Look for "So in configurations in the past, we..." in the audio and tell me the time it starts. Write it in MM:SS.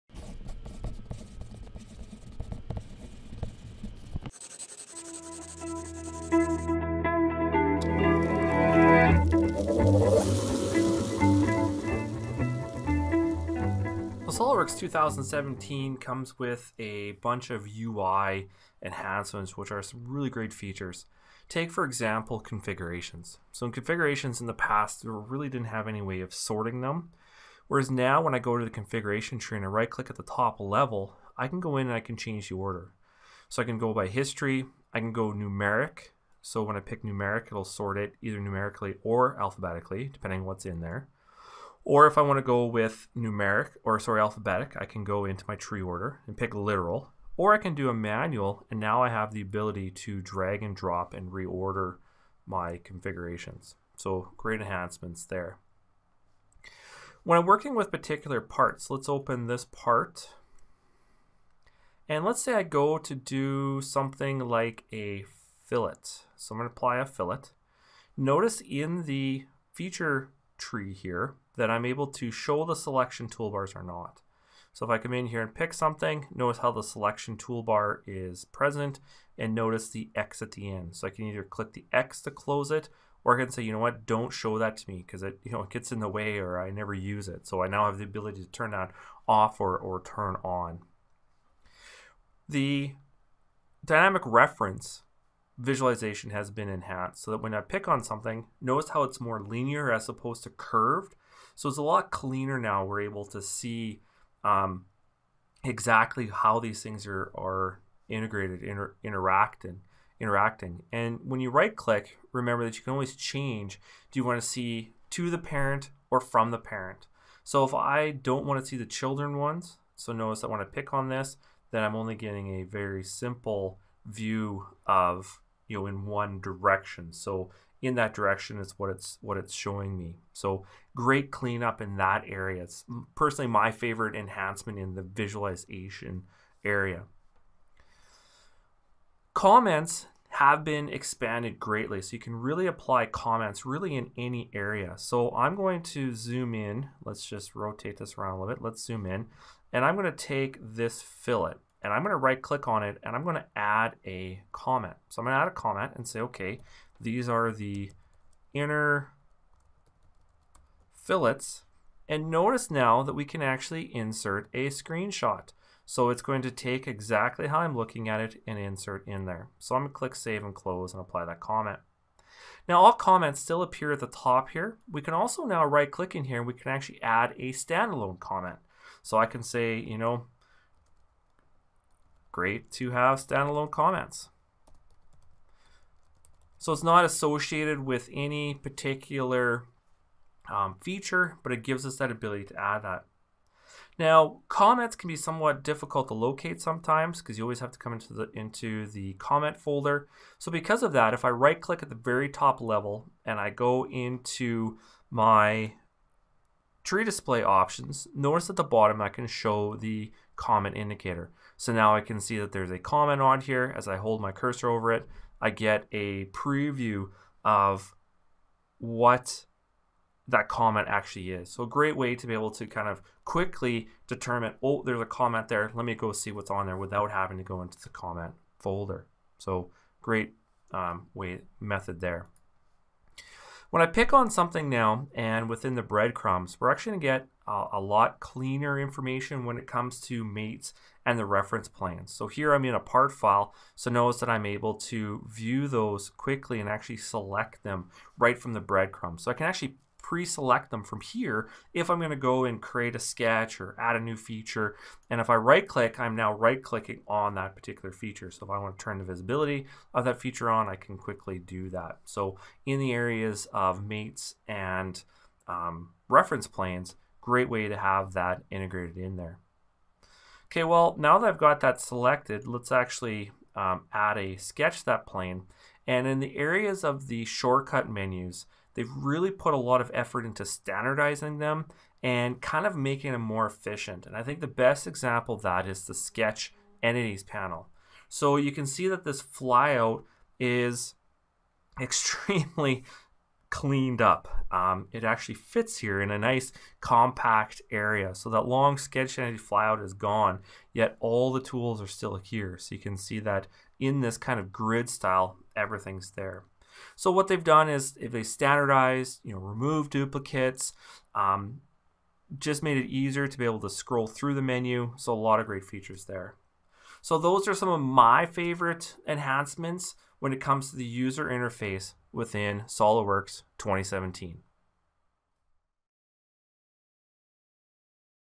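00:23.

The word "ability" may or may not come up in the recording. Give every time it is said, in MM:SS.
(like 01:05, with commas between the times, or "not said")
00:49, 01:28, 03:12.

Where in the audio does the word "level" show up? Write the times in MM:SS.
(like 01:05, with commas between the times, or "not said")
00:30, 03:22.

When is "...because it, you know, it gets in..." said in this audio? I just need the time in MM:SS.
01:25.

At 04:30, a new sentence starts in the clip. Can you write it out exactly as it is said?
Okay, well, now that I've got that selected, let's actually um, add a sketch to that plane.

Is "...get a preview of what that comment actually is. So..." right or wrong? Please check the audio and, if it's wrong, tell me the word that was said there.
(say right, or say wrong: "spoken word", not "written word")
right.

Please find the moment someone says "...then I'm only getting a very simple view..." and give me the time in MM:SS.
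02:01.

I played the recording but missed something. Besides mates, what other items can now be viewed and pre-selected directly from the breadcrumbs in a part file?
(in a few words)
reference planes.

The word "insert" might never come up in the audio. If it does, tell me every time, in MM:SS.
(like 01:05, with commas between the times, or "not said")
02:43, 02:48.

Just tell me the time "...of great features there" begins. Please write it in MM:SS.
05:15.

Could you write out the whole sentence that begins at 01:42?
We're able to see um, exactly how these things are, are integrated, inter- interact, and interacting.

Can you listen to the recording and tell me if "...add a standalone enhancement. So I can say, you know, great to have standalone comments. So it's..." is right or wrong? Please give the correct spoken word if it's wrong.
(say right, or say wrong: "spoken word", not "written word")
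wrong: "comment", not "enhancement".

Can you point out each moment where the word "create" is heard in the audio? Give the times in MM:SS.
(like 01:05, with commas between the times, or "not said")
04:12.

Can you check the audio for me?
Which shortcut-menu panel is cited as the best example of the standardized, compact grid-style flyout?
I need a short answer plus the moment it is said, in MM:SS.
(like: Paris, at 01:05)
Sketch Entities, at 04:45.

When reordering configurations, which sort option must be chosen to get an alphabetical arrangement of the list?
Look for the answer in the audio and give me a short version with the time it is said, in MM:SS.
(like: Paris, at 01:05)
literal, at 00:46.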